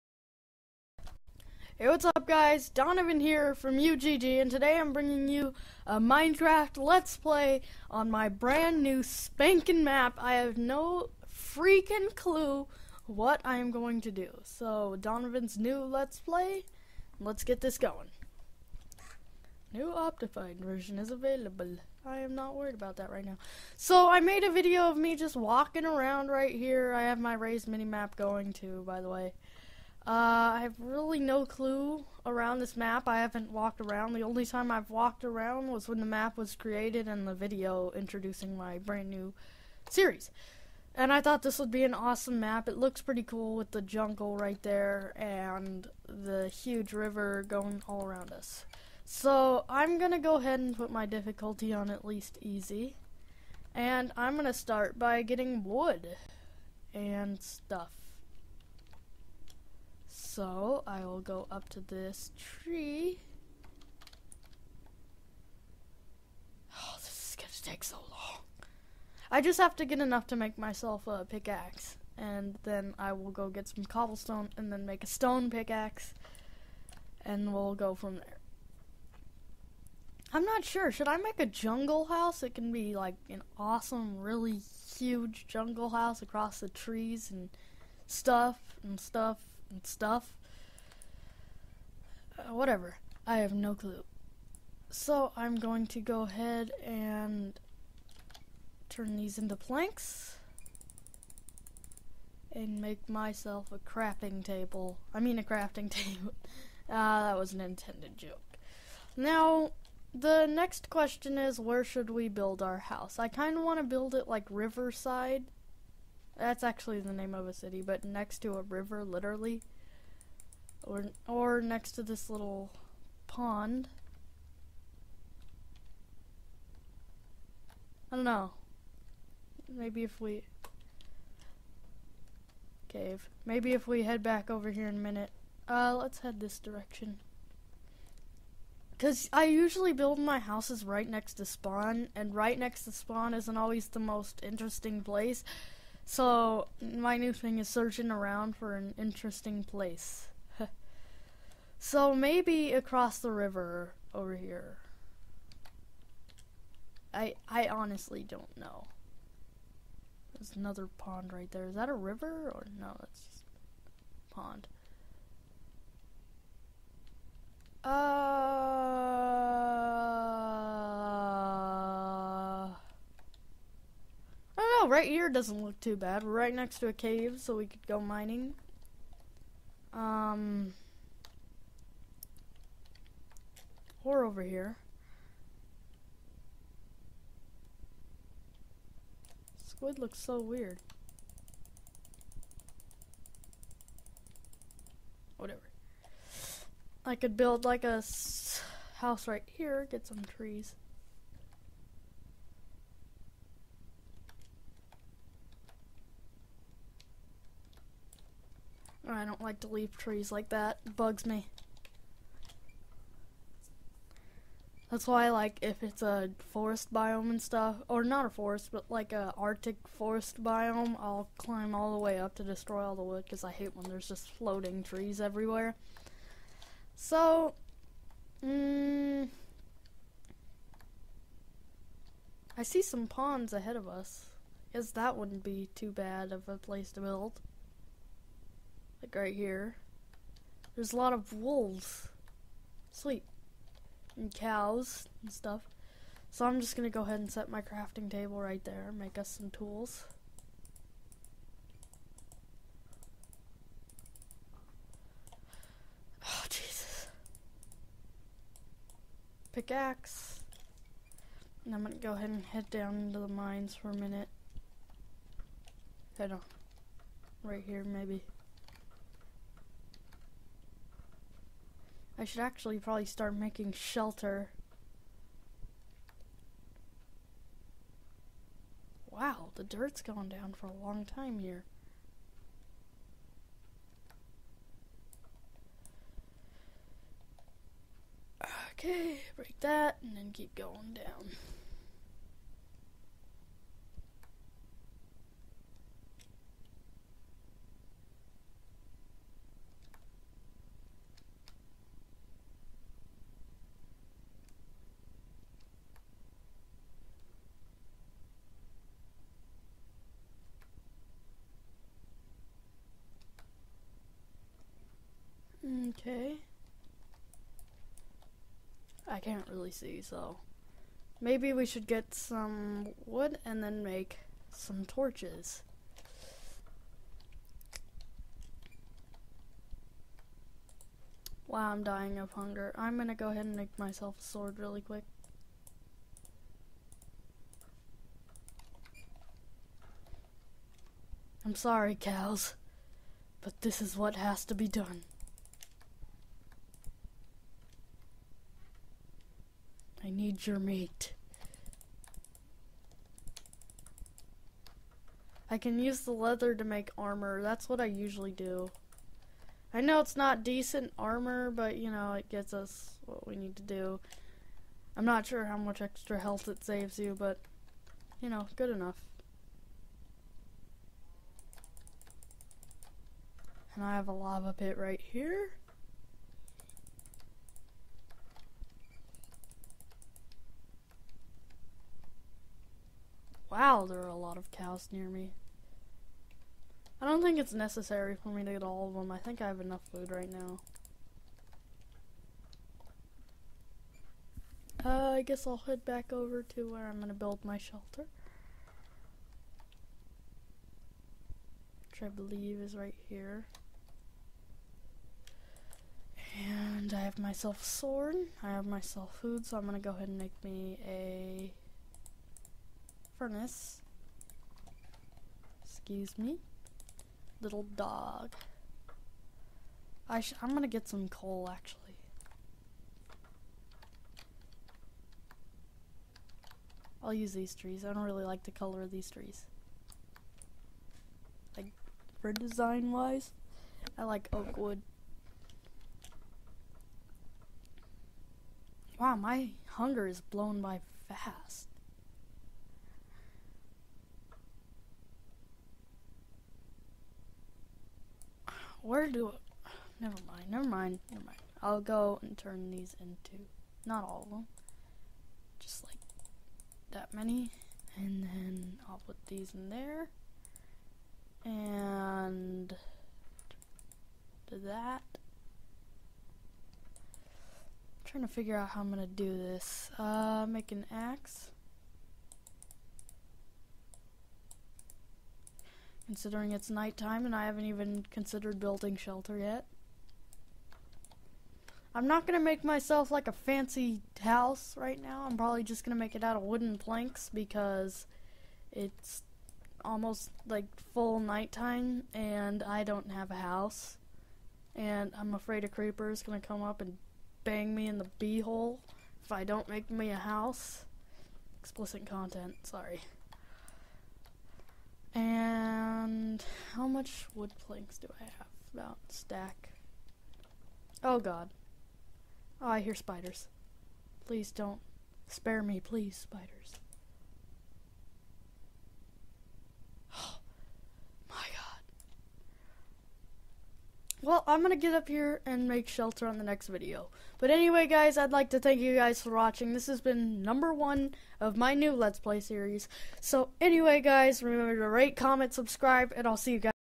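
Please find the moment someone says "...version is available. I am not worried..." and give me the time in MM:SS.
00:20.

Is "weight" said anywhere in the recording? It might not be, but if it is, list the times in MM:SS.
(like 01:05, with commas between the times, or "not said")
not said.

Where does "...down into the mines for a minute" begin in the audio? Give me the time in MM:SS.
04:22.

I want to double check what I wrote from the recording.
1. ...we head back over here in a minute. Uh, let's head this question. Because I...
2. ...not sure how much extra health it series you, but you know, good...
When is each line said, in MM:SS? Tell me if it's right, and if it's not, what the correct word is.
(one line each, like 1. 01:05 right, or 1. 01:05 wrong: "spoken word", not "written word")
1. 02:13 wrong: "direction", not "question"
2. 06:05 wrong: "saves", not "series".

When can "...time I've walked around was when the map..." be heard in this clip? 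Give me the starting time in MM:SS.
00:34.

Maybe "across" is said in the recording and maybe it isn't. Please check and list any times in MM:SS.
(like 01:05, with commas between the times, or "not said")
01:26, 02:32.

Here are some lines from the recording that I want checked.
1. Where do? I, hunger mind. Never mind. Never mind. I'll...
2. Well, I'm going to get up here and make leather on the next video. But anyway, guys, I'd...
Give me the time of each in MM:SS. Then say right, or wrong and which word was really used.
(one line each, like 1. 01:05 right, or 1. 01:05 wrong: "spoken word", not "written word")
1. 07:28 wrong: "never", not "hunger"
2. 08:44 wrong: "shelter", not "leather".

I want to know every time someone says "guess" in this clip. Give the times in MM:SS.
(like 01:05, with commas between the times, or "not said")
03:54, 06:35.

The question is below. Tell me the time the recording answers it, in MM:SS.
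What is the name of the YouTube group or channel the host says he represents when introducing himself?
00:03.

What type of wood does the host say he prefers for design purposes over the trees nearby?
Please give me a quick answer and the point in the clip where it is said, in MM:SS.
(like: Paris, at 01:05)
oak, at 07:14.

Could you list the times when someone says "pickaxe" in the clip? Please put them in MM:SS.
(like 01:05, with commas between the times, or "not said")
01:11, 01:15, 04:19.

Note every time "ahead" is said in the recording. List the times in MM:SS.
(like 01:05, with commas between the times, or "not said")
00:50, 01:36, 03:53, 04:07, 04:22, 05:33, 06:49.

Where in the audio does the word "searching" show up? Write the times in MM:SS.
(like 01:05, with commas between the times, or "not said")
02:27.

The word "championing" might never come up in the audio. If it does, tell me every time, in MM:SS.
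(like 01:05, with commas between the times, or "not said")
not said.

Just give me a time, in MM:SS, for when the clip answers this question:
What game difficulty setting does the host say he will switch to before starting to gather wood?
00:52.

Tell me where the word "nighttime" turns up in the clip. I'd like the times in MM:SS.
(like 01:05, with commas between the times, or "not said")
07:56, 08:11.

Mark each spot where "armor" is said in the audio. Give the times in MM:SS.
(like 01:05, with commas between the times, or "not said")
05:56, 06:00.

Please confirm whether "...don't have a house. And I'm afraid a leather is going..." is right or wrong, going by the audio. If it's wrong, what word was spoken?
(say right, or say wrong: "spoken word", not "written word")
wrong: "creeper", not "leather".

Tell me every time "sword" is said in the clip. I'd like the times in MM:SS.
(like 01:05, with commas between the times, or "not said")
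05:34, 06:47.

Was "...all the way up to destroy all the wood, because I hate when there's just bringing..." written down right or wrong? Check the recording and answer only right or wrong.
wrong.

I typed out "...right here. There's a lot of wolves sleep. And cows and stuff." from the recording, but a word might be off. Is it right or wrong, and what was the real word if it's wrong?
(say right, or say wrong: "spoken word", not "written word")
right.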